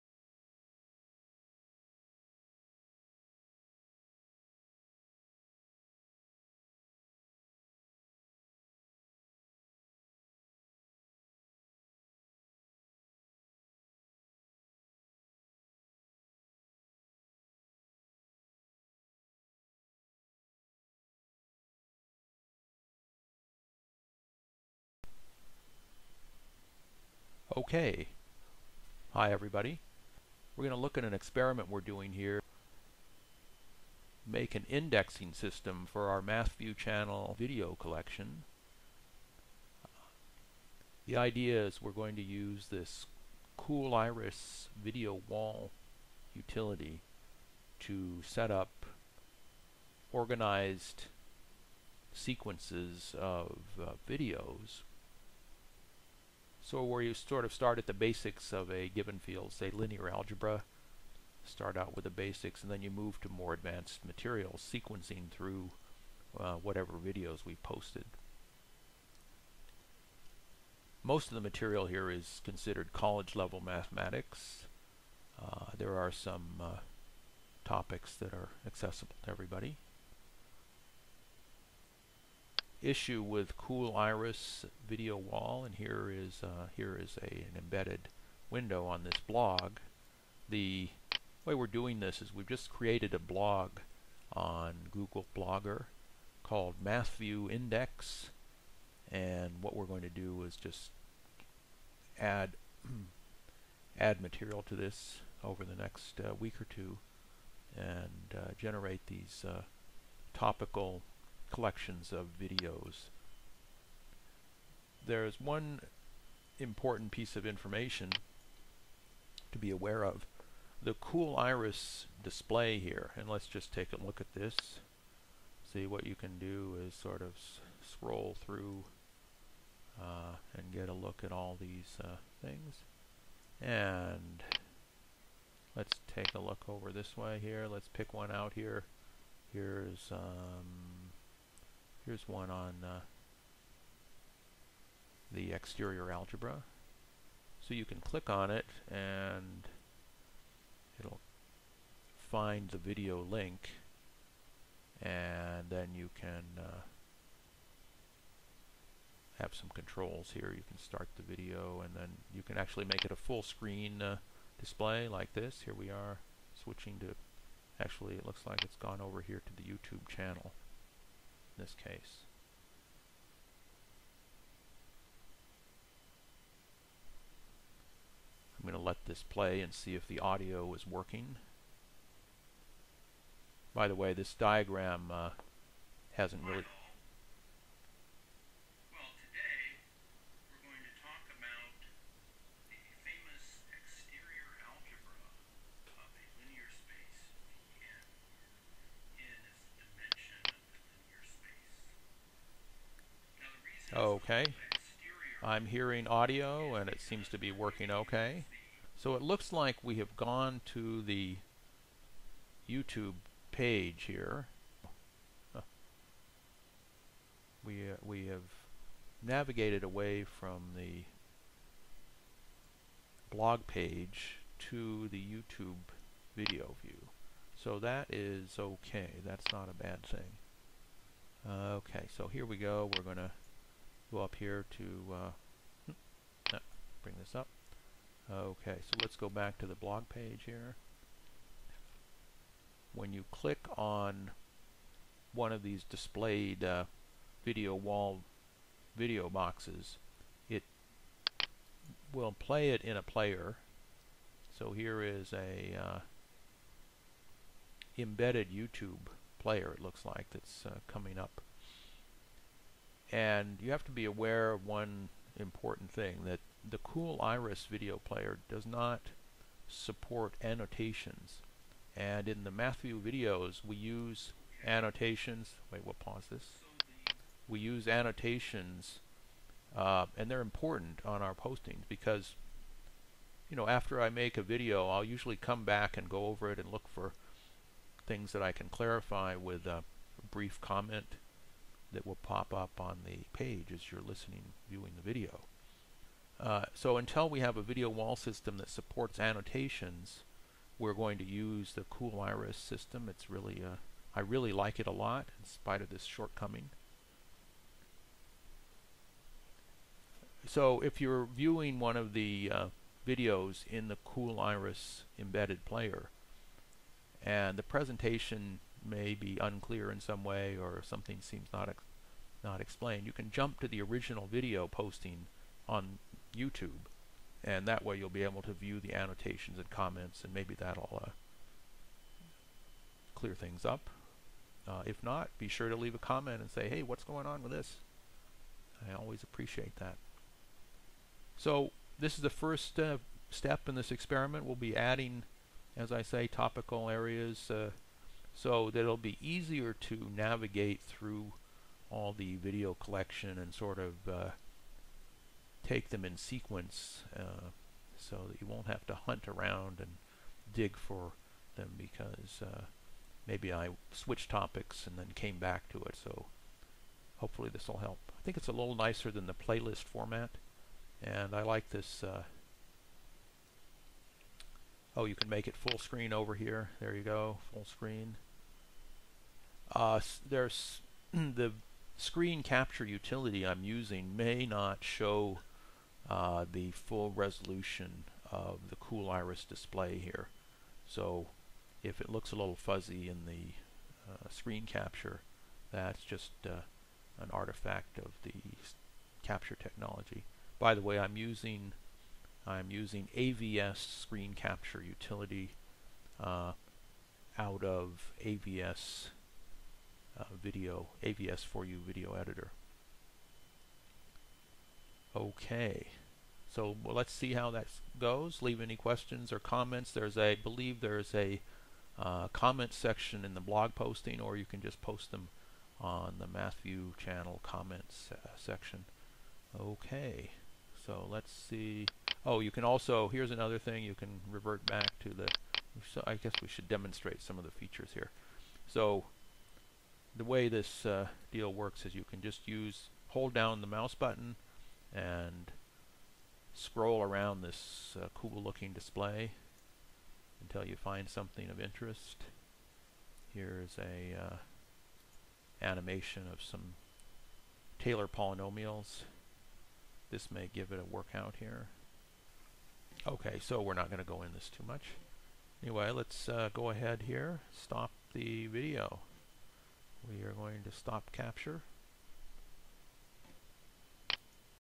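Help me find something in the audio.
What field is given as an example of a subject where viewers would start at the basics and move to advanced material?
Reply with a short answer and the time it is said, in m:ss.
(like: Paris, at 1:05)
linear algebra, at 0:59.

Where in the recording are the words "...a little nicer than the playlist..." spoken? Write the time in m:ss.
6:08.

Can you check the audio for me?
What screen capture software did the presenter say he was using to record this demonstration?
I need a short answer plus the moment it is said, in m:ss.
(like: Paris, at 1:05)
AVS Screen Capture, at 6:43.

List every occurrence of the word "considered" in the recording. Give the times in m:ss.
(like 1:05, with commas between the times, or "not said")
1:12.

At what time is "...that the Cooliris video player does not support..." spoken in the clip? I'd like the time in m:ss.
4:26.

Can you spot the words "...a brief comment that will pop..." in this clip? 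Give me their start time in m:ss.
4:49.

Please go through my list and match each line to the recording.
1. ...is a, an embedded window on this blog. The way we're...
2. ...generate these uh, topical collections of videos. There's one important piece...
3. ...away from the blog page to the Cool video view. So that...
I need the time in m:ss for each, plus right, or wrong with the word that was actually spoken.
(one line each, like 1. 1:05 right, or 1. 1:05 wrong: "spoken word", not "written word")
1. 1:27 right
2. 1:48 right
3. 3:39 wrong: "YouTube", not "Cool".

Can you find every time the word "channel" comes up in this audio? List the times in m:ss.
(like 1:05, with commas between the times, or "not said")
0:36, 2:50, 7:06.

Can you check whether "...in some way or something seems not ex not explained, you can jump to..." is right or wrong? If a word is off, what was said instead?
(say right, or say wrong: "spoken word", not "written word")
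right.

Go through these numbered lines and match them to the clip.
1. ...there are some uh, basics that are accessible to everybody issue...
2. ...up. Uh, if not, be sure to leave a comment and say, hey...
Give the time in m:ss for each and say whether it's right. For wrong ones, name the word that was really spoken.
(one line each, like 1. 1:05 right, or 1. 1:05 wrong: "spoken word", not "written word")
1. 1:15 wrong: "topics", not "basics"
2. 5:33 right.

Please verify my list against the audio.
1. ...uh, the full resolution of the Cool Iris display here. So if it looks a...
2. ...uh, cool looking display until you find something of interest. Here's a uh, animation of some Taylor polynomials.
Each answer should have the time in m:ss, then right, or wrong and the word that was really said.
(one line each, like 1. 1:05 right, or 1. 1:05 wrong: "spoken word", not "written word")
1. 6:26 right
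2. 7:27 right.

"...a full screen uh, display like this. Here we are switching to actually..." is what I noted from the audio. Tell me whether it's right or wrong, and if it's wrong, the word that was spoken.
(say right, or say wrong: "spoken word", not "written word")
right.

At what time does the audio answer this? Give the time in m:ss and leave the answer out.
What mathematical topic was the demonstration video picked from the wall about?
2:25.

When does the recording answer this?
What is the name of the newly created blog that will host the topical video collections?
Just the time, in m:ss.
1:36.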